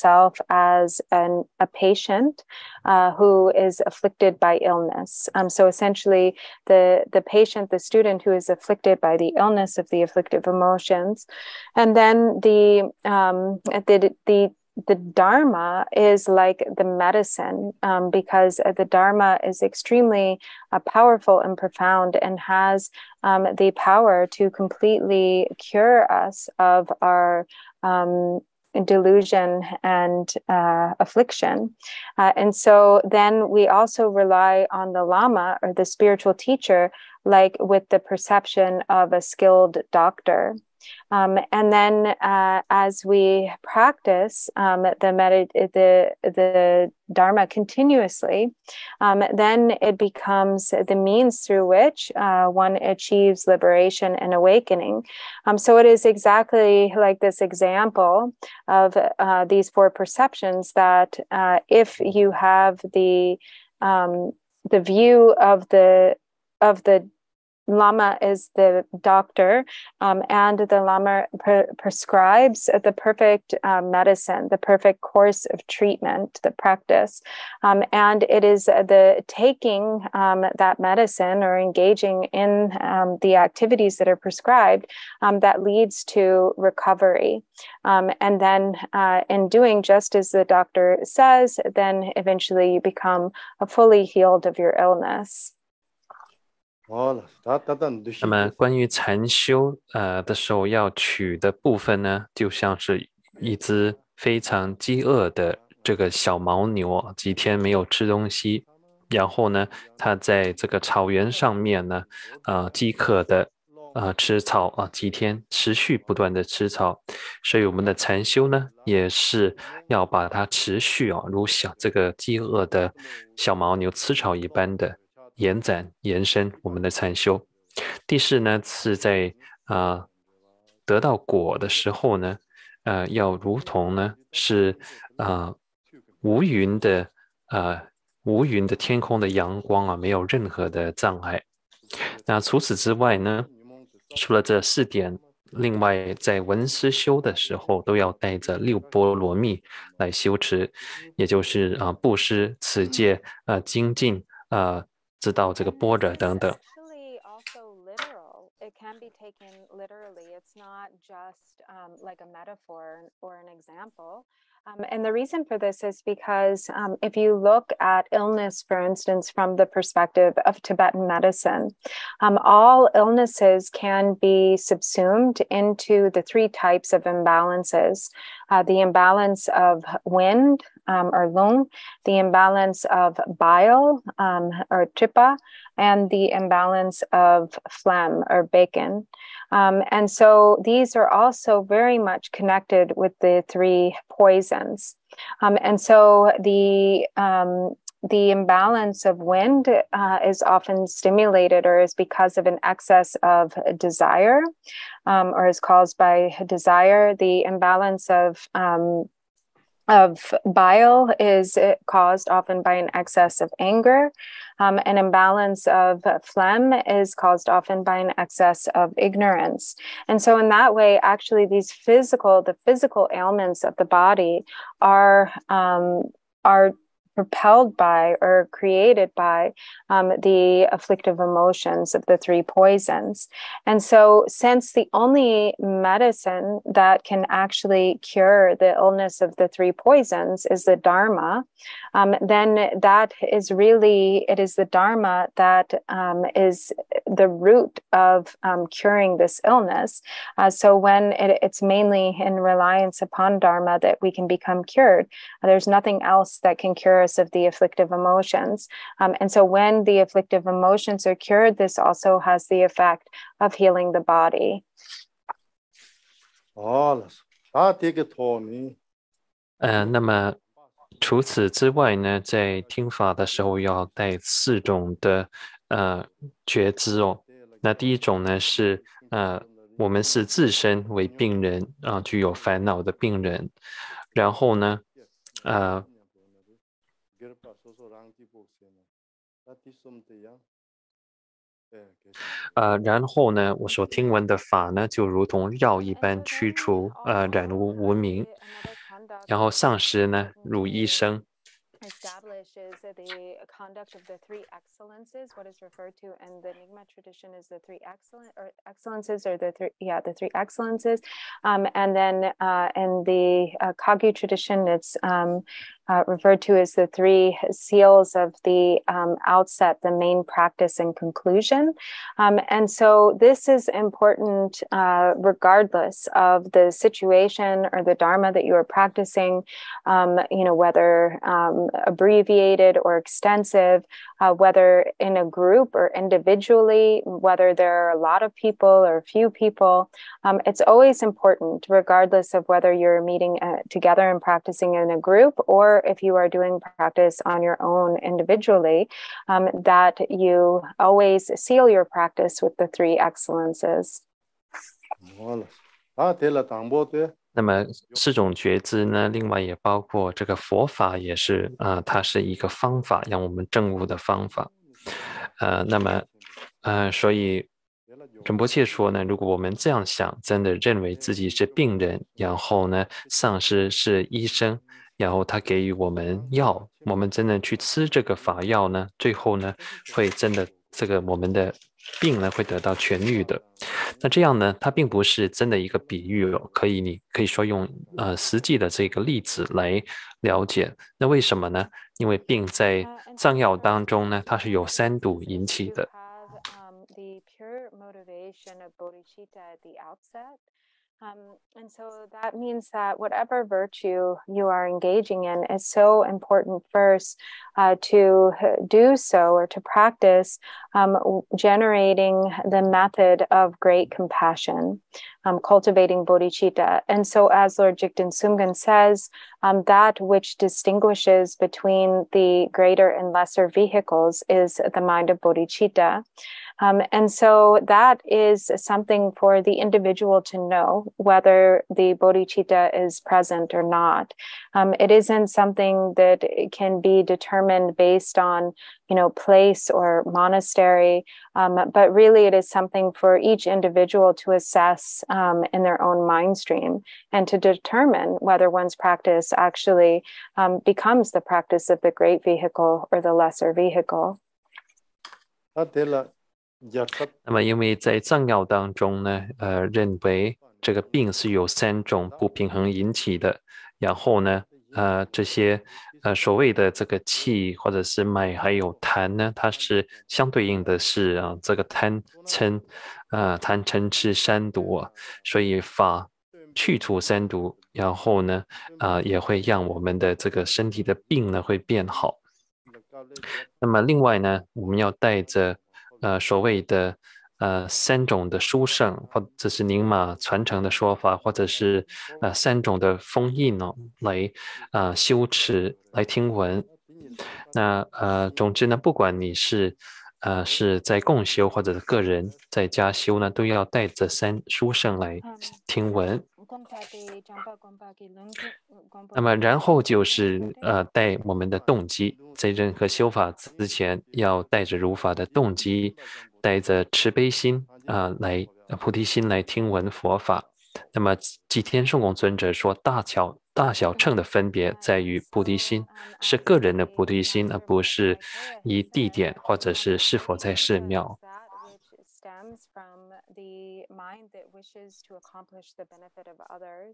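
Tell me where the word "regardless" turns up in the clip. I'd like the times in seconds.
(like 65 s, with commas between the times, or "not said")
325 s, 341 s.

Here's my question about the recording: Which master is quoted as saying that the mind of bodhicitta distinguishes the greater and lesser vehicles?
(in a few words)
Jigten Sumgön.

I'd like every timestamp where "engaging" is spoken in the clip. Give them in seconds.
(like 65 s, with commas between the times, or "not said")
81 s, 404 s.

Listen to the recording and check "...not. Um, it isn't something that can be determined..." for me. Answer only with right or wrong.
right.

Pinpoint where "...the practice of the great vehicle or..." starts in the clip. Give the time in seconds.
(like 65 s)
451 s.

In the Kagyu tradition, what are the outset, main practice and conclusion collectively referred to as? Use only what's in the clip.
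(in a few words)
the three seals.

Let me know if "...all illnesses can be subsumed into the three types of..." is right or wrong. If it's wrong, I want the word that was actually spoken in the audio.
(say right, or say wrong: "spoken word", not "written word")
right.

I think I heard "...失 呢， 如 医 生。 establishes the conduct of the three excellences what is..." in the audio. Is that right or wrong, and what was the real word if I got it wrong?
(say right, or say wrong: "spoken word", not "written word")
right.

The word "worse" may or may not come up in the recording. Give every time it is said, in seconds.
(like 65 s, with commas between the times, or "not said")
not said.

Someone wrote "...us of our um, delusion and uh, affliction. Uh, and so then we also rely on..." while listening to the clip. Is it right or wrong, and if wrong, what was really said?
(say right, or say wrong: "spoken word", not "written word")
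right.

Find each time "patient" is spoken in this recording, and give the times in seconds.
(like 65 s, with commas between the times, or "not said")
1 s, 7 s.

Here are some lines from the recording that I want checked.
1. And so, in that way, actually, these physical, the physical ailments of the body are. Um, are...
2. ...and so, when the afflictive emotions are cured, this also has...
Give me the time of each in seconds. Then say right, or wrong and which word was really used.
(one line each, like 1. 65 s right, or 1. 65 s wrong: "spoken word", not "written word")
1. 220 s right
2. 259 s right.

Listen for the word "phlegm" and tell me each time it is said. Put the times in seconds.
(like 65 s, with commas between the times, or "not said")
187 s, 216 s.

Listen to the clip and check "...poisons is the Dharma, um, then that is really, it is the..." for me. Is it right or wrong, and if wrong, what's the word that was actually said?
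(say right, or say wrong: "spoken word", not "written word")
right.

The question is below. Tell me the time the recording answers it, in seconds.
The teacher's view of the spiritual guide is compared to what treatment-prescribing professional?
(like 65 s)
39 s.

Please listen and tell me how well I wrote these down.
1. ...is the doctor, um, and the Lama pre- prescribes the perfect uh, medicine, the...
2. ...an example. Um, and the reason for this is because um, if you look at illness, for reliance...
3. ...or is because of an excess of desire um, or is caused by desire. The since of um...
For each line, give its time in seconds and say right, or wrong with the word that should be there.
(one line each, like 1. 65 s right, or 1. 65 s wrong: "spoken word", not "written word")
1. 68 s right
2. 163 s wrong: "instance", not "reliance"
3. 201 s wrong: "imbalance", not "since".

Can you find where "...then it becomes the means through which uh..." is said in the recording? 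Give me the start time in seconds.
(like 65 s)
49 s.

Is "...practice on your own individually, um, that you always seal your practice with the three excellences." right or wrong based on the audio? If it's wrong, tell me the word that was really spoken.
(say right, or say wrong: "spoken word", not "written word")
right.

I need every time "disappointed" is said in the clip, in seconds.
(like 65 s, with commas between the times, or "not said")
not said.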